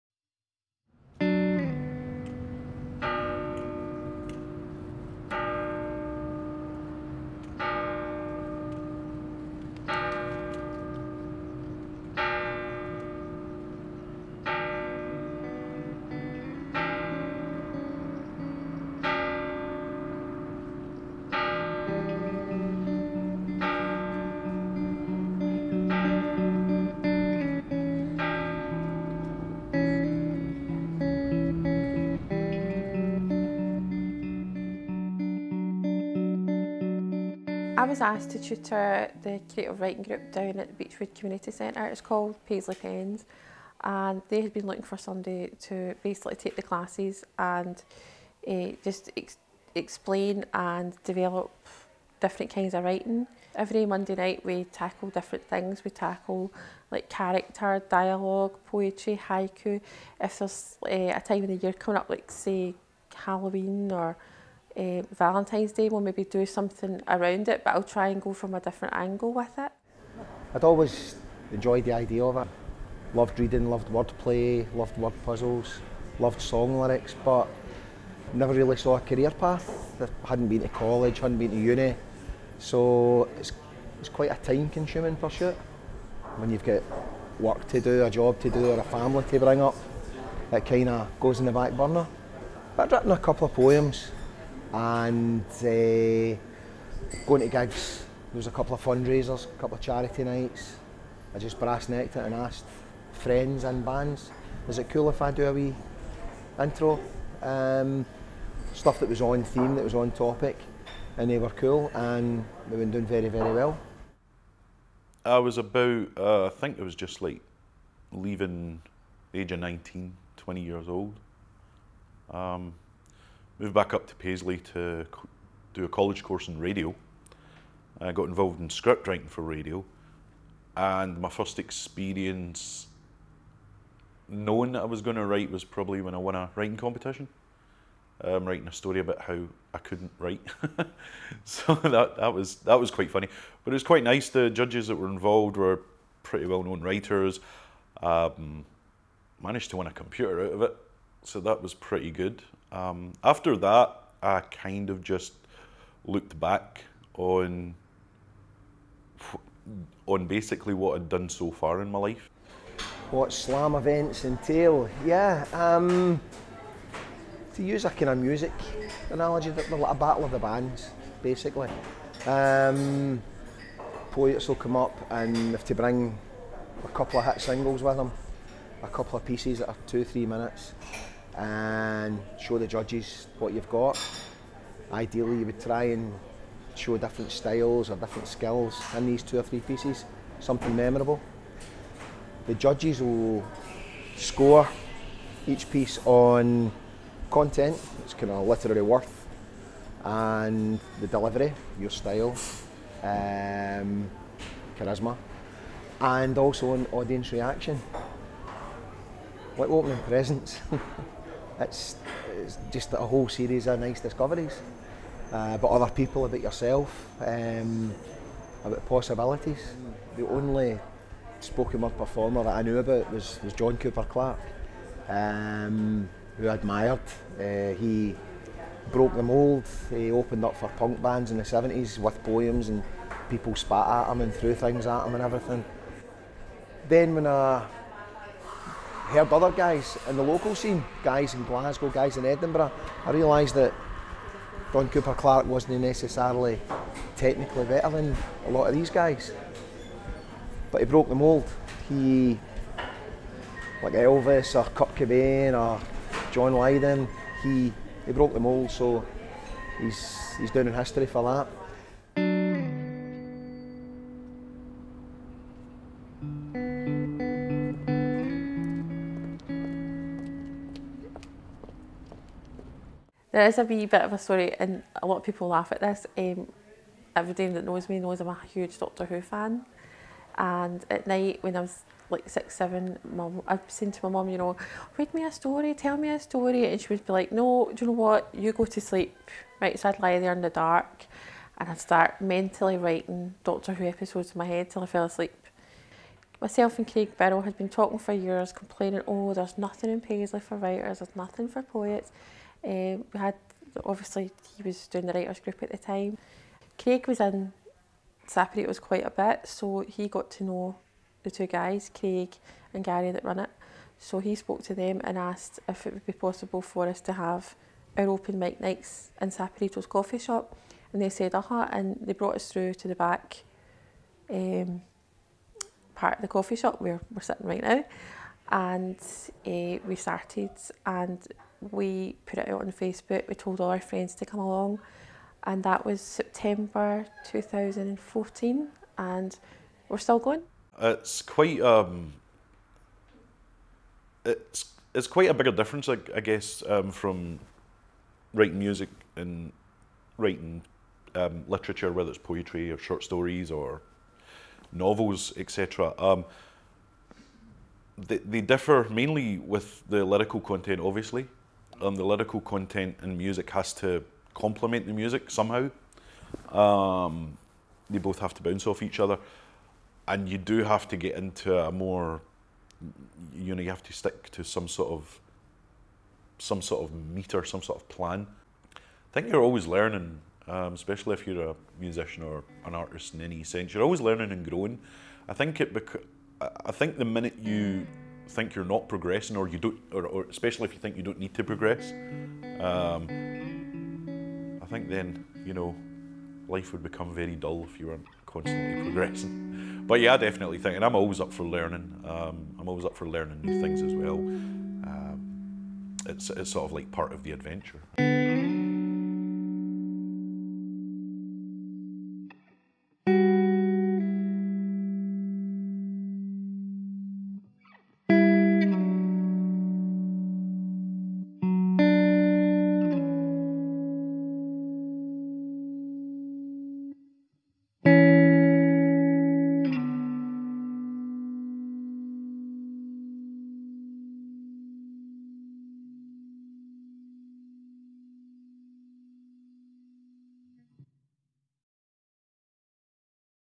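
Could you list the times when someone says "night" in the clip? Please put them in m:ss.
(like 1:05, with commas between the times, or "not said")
0:54, 1:40, 4:41, 5:18.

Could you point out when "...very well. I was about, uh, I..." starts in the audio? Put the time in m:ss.
1:53.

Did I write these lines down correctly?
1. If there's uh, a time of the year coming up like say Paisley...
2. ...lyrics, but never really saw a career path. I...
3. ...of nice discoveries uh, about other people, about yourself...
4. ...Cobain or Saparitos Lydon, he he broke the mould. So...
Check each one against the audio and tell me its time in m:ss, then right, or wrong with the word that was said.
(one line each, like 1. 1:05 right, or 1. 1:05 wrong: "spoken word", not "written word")
1. 1:00 wrong: "Halloween", not "Paisley"
2. 1:16 right
3. 3:33 right
4. 4:14 wrong: "John", not "Saparitos".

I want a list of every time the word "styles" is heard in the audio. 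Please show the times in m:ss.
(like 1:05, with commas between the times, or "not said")
3:07, 3:21.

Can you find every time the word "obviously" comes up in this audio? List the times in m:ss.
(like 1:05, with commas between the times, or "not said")
5:03, 6:00.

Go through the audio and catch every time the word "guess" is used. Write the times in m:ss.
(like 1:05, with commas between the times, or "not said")
5:46.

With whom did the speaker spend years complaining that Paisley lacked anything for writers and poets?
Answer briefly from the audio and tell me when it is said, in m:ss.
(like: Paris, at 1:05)
Craig Barrow, at 4:56.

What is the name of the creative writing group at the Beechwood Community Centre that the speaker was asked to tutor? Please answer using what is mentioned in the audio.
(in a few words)
Paisley Pens.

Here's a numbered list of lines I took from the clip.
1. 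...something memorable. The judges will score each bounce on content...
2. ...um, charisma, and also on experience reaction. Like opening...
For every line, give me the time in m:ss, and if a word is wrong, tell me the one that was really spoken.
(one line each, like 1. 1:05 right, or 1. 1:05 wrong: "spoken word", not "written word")
1. 3:10 wrong: "piece", not "bounce"
2. 3:23 wrong: "audience", not "experience".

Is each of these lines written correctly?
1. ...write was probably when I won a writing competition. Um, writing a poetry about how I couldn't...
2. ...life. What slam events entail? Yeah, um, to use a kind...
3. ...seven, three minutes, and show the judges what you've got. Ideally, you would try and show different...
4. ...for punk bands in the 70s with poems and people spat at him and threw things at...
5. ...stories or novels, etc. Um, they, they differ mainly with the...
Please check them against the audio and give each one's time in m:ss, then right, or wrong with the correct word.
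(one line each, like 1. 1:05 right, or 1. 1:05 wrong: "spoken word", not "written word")
1. 2:15 wrong: "story", not "poetry"
2. 2:41 right
3. 2:59 wrong: "two", not "seven"
4. 3:50 right
5. 5:53 right.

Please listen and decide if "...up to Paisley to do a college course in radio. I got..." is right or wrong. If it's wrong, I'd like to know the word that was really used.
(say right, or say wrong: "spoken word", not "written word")
right.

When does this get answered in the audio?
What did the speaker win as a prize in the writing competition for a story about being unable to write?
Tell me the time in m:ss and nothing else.
2:29.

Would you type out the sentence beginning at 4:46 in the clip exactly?
And she would be like, no, do you know what?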